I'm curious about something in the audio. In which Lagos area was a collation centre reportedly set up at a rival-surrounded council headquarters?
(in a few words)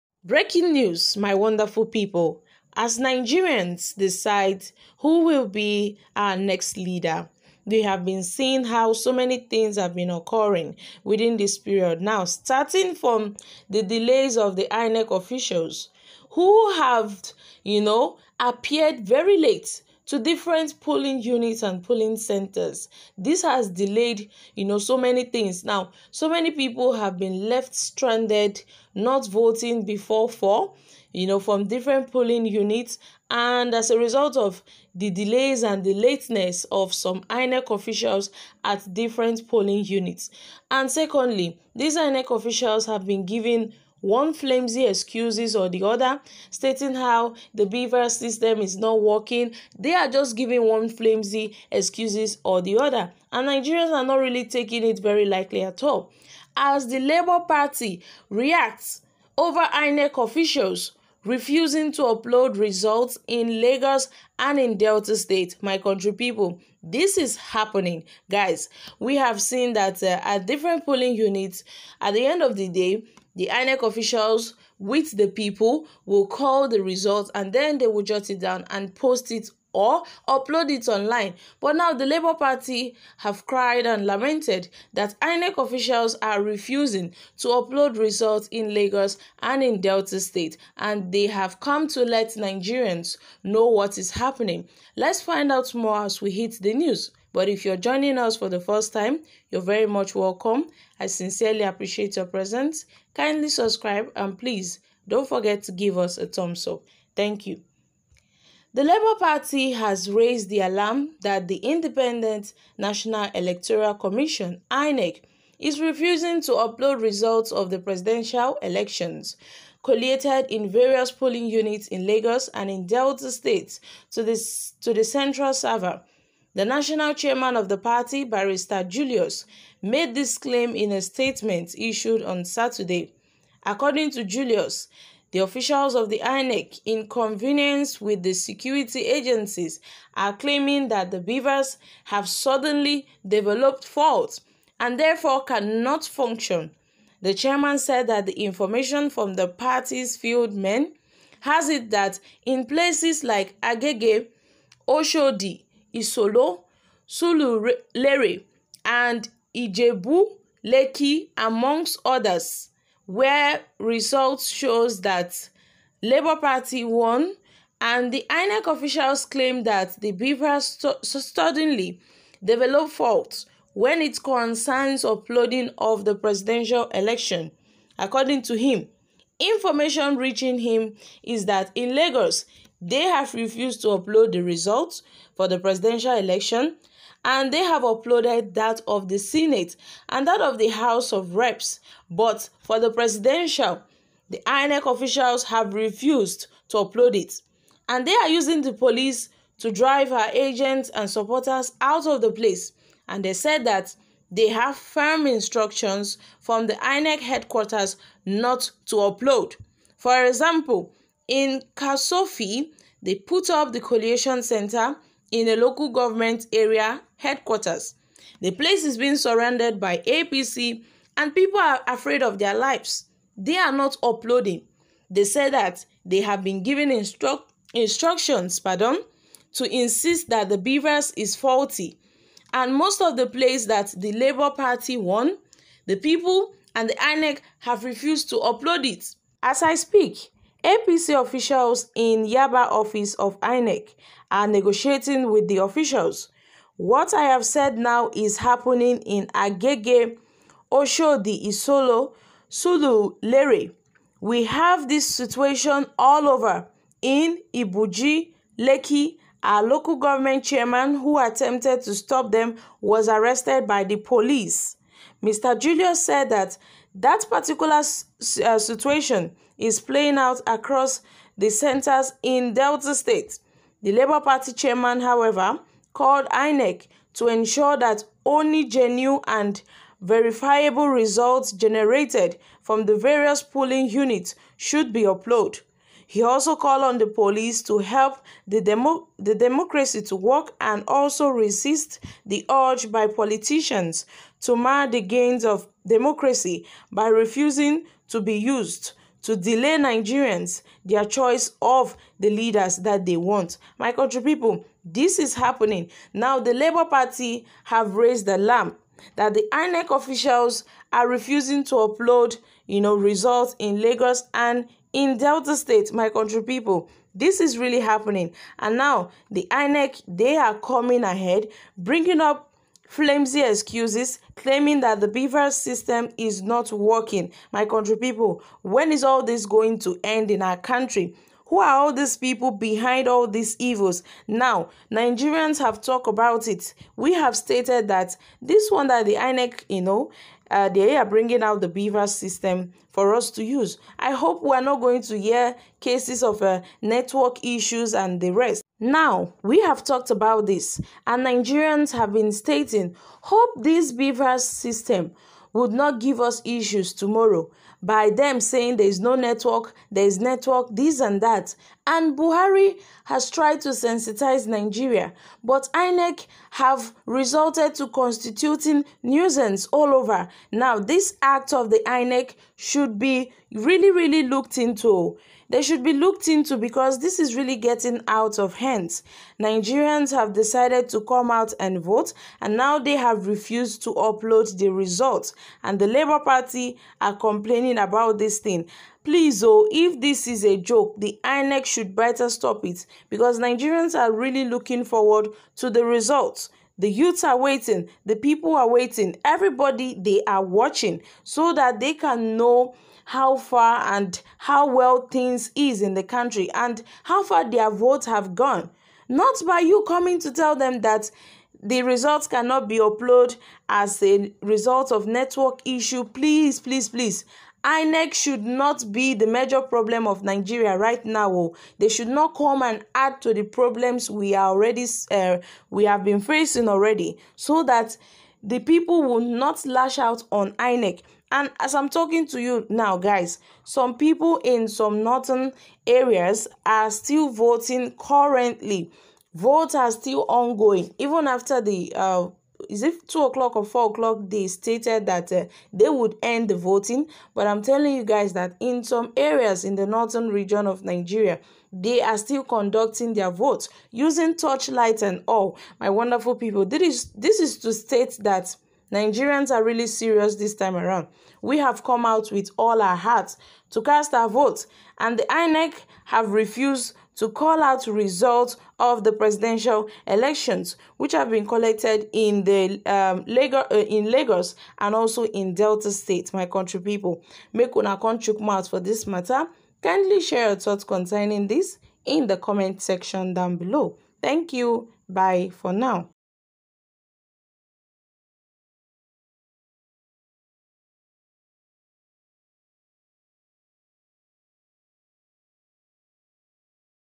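Kosofe.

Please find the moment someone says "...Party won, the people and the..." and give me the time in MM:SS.
03:54.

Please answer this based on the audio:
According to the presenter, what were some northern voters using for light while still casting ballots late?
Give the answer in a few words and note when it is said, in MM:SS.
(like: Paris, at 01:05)
torchlight, at 07:34.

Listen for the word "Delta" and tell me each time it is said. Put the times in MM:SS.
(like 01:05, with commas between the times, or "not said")
01:04, 01:29, 02:02, 04:32, 05:15, 07:55.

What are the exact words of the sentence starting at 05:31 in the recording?
Who are all these people behind all these evils?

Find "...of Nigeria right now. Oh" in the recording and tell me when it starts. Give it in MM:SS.
07:00.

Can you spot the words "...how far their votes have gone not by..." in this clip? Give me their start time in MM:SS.
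06:47.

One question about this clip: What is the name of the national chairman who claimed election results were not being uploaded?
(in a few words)
Barrister Julius.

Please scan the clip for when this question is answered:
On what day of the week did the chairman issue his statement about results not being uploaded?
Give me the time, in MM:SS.
02:12.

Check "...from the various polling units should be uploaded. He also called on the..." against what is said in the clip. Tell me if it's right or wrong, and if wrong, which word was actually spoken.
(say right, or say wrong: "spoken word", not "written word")
right.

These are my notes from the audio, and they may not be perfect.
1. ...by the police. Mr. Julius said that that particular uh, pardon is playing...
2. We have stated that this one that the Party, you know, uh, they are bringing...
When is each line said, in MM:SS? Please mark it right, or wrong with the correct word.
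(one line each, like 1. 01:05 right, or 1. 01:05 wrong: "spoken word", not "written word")
1. 04:23 wrong: "situation", not "pardon"
2. 05:36 wrong: "INEC", not "Party".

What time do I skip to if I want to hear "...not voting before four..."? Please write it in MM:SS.
00:28.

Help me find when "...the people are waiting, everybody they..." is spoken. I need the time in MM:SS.
06:38.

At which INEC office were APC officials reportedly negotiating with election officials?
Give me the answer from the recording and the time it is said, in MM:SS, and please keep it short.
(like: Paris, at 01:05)
Yaba, at 04:02.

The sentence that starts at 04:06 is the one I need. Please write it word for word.
What I have said now is happening in Agege, Oshodi Isolo, Sulu-Lere.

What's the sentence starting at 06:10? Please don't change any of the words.
Now, this act of the INEC should be really, really looked into.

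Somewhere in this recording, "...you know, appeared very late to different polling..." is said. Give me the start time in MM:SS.
00:17.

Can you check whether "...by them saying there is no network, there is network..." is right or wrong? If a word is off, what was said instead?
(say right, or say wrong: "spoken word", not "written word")
right.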